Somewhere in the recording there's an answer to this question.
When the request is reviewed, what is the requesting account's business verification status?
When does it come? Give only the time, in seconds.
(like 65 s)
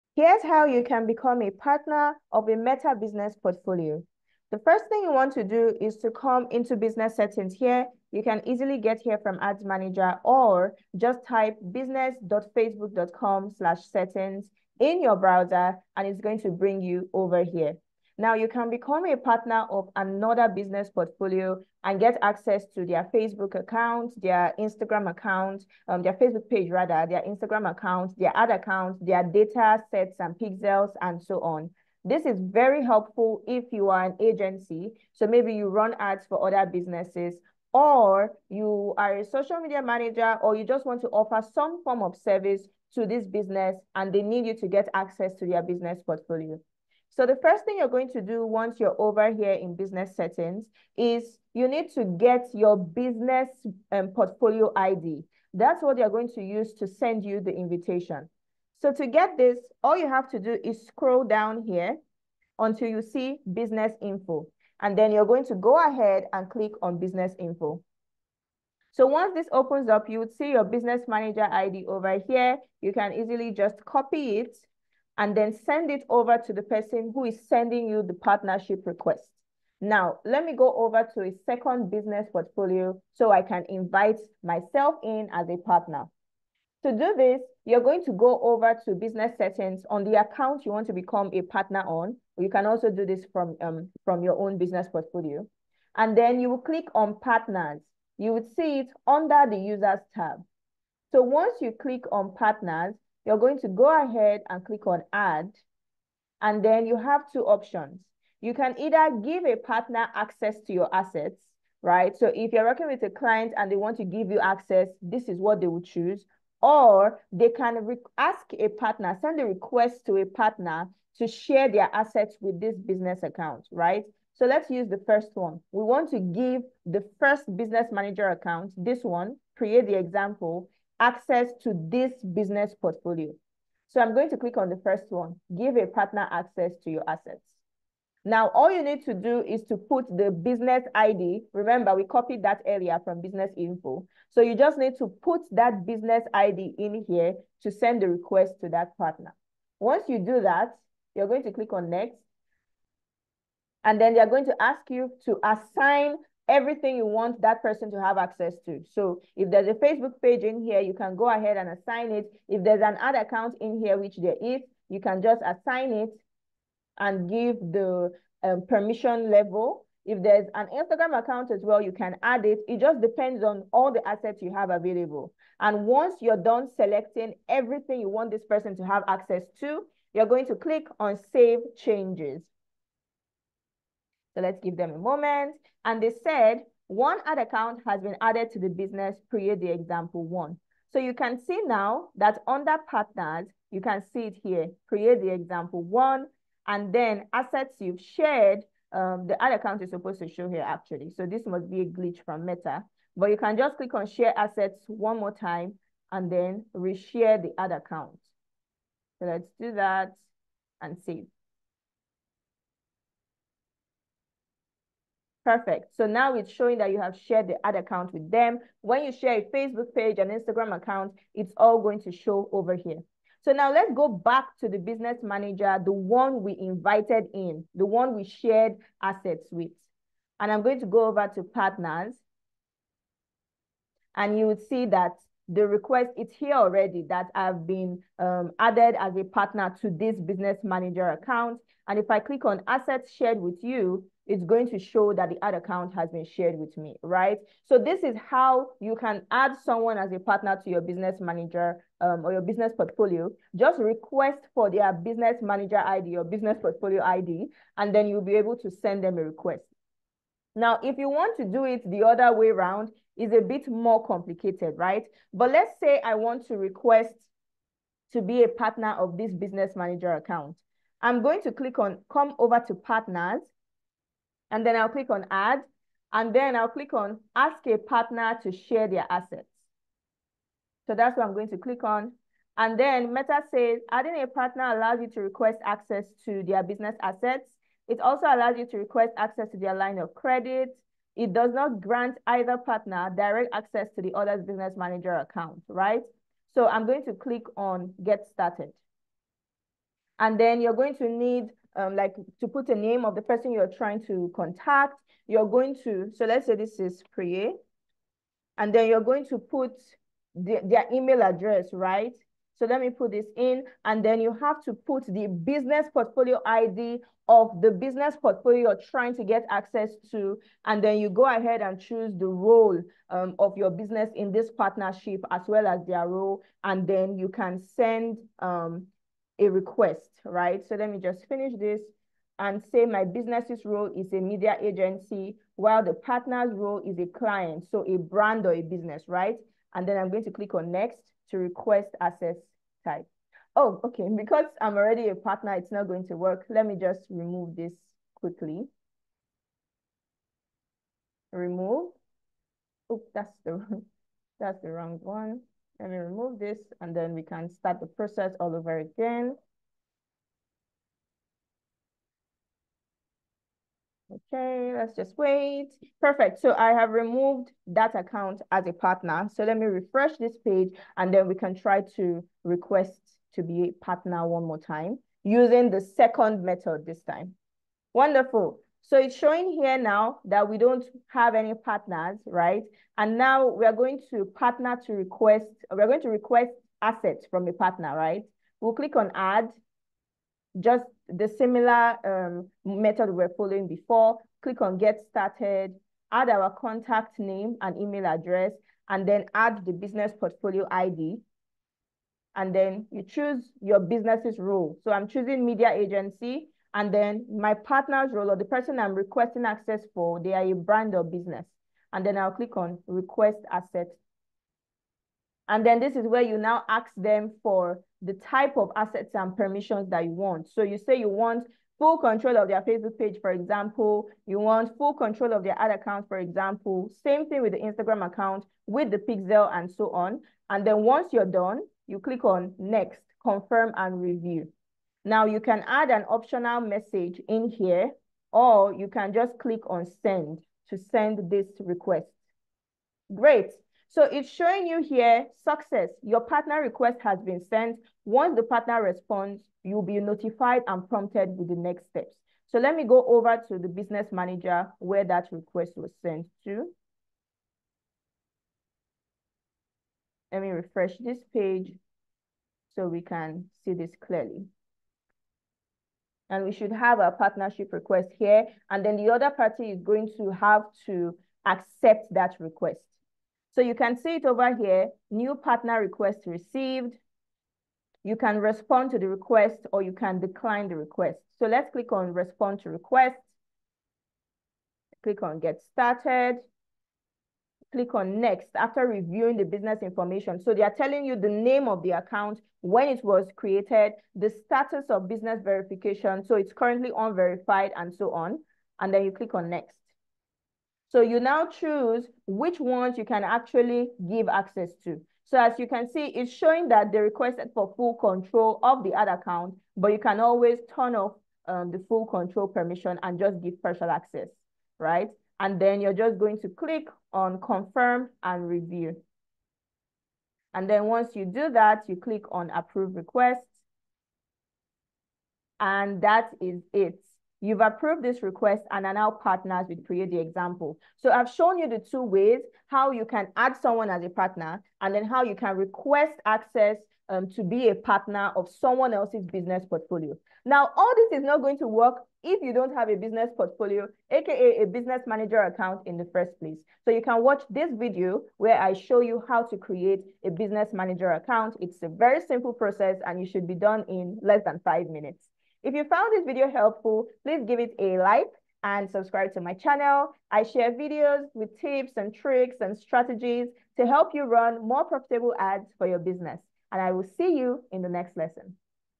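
496 s.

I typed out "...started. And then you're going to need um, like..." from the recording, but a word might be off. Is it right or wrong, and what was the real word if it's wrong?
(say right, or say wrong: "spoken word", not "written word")
right.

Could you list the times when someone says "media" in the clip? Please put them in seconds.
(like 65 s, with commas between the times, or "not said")
39 s, 334 s, 405 s.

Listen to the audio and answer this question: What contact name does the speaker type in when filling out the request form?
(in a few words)
Priya.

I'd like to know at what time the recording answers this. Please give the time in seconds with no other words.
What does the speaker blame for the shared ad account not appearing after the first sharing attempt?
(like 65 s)
201 s.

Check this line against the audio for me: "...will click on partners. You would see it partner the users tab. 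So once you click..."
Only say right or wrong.
wrong.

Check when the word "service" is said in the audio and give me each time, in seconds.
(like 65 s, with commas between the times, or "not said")
42 s.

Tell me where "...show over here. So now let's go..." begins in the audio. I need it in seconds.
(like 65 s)
222 s.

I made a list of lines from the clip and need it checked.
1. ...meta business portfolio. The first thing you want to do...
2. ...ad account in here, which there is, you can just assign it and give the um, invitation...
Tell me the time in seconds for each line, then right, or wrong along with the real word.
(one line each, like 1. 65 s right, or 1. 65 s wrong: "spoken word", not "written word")
1. 2 s right
2. 162 s wrong: "permission", not "invitation".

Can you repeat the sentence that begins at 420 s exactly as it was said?
So you say you want full control of their Facebook page, for example.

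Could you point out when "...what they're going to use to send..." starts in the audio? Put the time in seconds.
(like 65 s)
55 s.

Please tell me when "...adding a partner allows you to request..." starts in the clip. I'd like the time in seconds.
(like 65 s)
283 s.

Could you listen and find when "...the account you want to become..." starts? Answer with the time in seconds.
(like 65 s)
90 s.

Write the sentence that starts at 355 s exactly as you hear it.
Let me remove this and then we can start the process all over again.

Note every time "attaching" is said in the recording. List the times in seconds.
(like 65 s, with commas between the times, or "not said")
not said.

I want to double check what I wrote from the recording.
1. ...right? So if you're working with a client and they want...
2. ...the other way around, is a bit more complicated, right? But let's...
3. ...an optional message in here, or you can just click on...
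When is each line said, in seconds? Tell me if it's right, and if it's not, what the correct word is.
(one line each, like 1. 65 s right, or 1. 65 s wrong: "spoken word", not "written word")
1. 111 s right
2. 261 s right
3. 435 s right.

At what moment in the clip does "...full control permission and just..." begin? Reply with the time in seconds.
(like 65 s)
511 s.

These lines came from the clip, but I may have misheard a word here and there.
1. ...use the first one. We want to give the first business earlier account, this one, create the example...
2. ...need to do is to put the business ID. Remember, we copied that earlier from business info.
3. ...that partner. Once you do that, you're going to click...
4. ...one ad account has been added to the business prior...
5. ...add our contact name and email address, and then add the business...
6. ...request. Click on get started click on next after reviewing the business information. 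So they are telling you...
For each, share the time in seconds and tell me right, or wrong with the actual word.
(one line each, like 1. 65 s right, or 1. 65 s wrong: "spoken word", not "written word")
1. 124 s wrong: "manager", not "earlier"
2. 138 s right
3. 148 s right
4. 186 s right
5. 396 s right
6. 482 s right.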